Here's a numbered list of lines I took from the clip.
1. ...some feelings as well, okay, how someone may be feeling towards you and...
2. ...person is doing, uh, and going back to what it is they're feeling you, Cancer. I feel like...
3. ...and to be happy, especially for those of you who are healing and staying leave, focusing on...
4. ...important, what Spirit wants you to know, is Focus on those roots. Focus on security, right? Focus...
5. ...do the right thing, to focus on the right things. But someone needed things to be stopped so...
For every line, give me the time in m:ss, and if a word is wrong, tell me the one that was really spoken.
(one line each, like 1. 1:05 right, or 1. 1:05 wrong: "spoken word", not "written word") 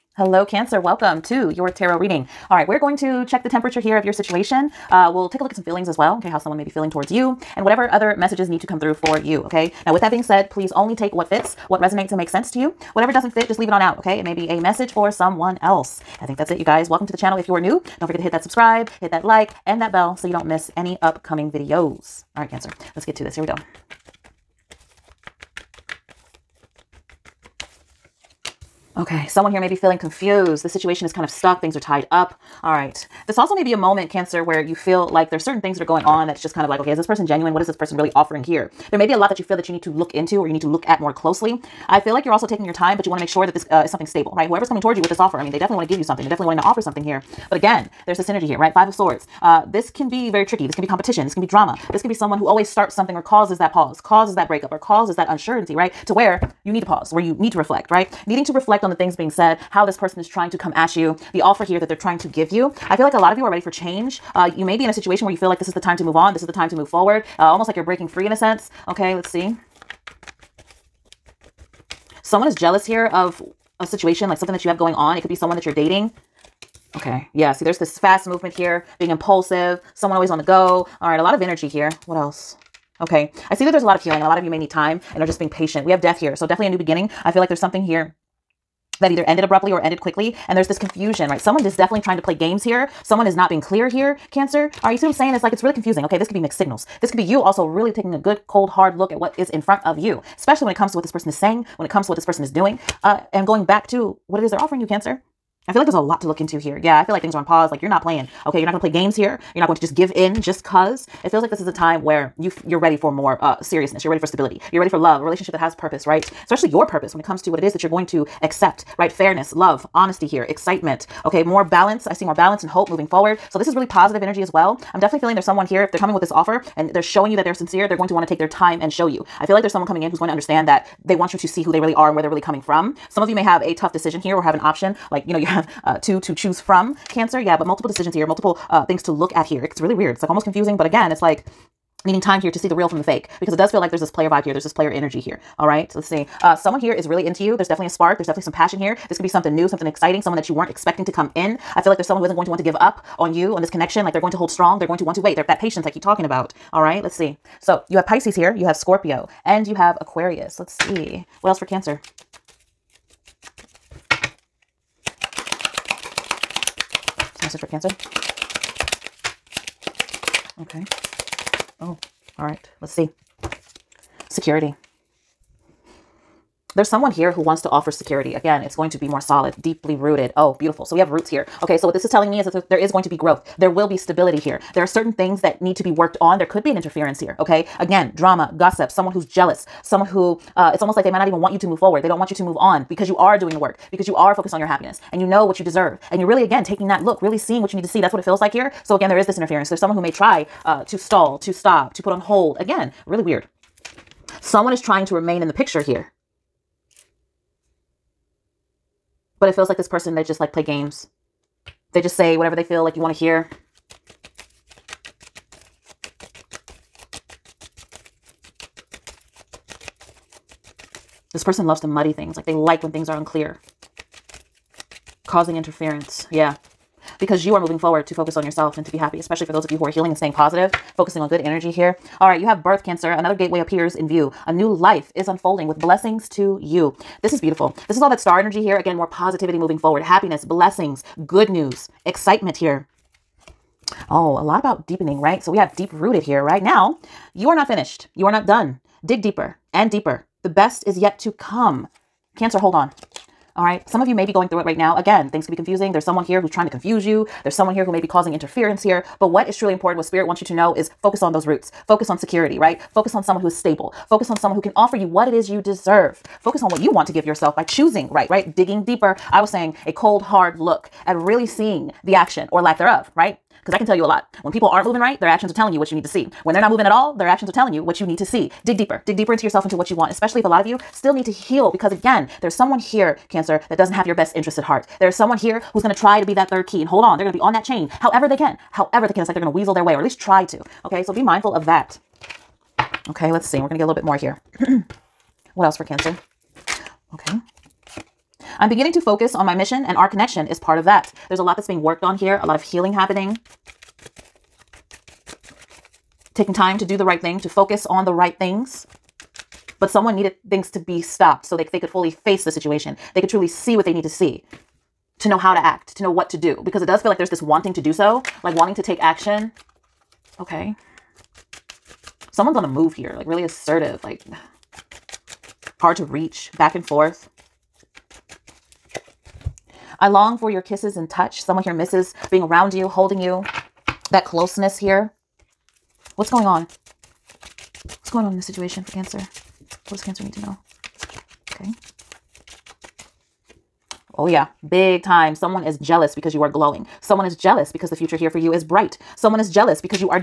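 1. 0:05 right
2. 1:42 wrong: "offering", not "feeling"
3. 3:48 wrong: "positive", not "leave"
4. 4:19 right
5. 5:06 right.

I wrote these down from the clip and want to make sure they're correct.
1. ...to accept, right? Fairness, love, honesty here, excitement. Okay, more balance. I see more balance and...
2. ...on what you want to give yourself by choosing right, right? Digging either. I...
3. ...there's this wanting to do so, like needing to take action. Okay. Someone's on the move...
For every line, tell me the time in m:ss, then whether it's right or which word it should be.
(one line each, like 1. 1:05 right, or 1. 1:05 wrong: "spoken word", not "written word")
1. 1:58 right
2. 4:26 wrong: "deeper", not "either"
3. 5:17 wrong: "wanting", not "needing".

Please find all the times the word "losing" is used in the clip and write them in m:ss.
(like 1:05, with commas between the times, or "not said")
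not said.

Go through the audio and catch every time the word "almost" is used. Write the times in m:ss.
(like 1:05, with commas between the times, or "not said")
1:07, 2:20, 3:10.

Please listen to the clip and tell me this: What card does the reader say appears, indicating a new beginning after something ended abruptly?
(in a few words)
Death.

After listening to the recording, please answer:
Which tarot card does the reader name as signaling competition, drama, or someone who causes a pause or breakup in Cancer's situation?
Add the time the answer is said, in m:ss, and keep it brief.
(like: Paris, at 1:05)
Five of Swords, at 0:48.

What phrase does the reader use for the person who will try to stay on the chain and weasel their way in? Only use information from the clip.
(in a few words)
third key.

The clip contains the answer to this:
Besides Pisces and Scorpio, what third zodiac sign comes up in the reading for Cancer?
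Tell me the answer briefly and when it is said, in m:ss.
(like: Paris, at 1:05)
Aquarius, at 2:40.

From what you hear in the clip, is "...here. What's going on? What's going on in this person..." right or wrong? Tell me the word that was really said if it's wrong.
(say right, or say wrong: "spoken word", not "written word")
wrong: "situation", not "person".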